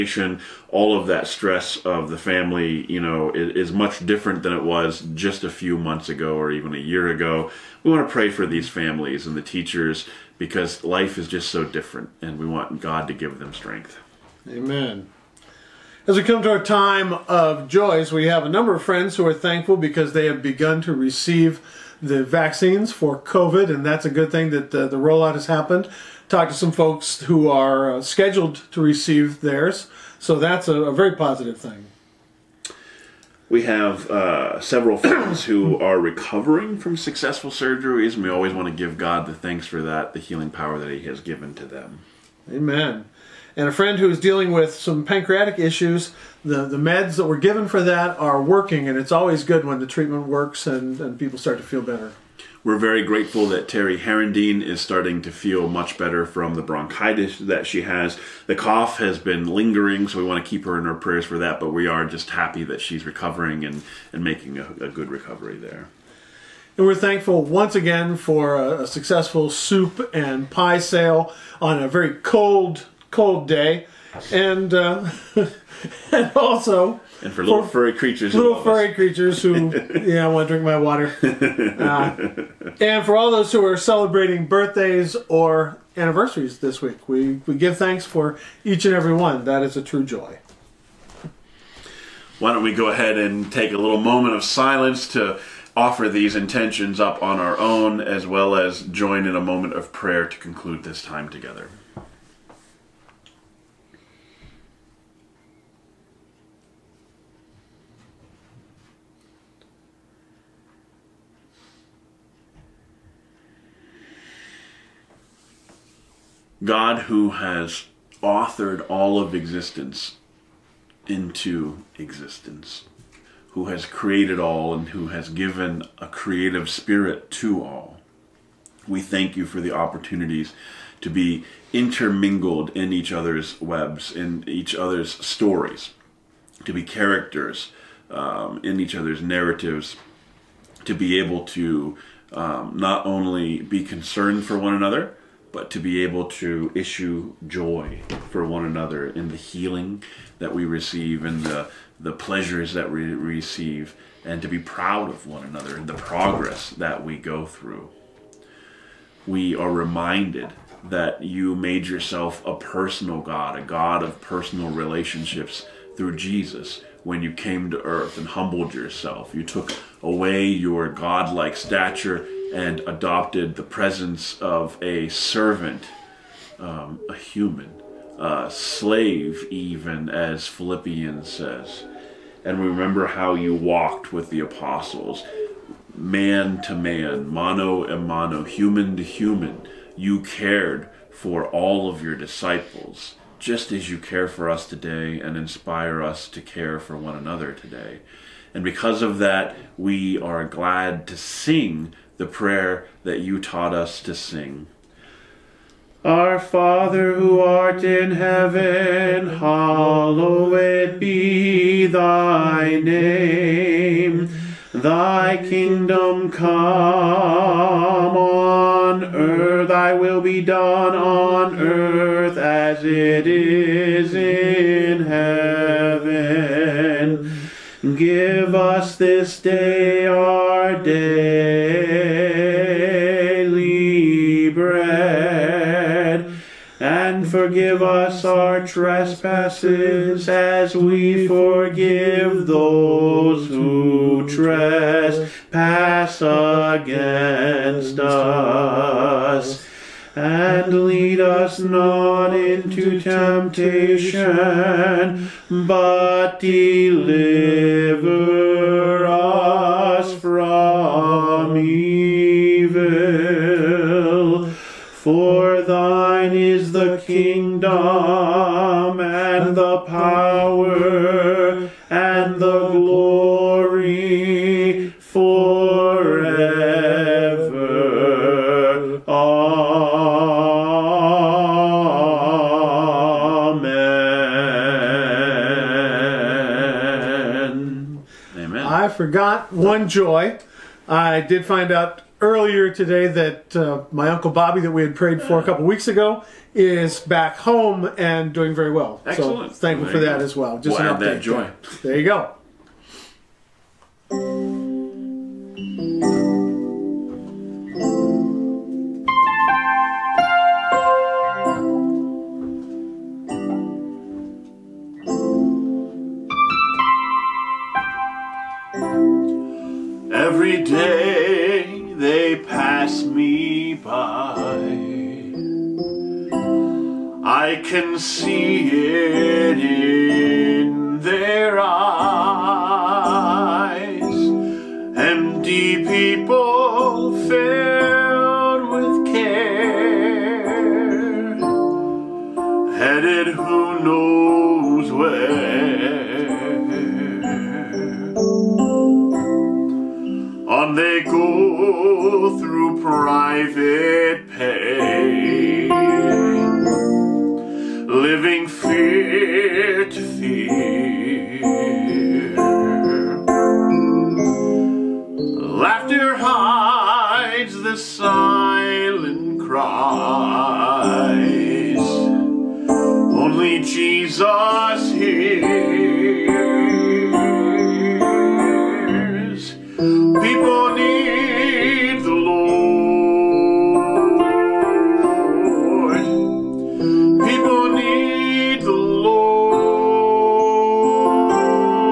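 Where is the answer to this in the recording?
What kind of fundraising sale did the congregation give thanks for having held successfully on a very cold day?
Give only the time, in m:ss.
1:09.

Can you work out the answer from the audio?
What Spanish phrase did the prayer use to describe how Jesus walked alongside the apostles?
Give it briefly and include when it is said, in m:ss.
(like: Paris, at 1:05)
mano a mano, at 3:07.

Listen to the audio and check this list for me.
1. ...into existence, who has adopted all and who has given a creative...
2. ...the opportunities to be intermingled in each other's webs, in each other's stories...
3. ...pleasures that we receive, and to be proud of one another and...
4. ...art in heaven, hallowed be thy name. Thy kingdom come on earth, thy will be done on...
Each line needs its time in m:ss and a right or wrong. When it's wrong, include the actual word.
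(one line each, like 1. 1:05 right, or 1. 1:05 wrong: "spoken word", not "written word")
1. 2:01 wrong: "created", not "adopted"
2. 2:09 right
3. 2:32 right
4. 3:27 right.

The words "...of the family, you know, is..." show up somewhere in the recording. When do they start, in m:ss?
0:01.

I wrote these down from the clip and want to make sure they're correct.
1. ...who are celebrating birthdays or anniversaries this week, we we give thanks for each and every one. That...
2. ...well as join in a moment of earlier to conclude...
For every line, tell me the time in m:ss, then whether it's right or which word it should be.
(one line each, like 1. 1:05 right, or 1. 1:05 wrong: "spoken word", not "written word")
1. 1:23 right
2. 1:38 wrong: "prayer", not "earlier".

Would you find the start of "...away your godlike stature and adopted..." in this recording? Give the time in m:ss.
2:50.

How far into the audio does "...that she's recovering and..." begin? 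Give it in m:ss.
1:02.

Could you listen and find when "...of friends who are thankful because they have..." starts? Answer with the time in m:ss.
0:18.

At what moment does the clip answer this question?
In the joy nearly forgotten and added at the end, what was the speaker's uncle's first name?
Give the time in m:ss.
4:54.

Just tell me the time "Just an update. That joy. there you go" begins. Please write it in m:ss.
5:00.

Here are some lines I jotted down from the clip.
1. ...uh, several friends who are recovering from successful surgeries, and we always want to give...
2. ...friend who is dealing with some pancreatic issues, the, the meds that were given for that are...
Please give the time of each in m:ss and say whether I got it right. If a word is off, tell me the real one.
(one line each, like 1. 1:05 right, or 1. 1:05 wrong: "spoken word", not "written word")
1. 0:34 right
2. 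0:43 right.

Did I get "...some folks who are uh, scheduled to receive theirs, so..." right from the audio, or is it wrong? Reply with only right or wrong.
right.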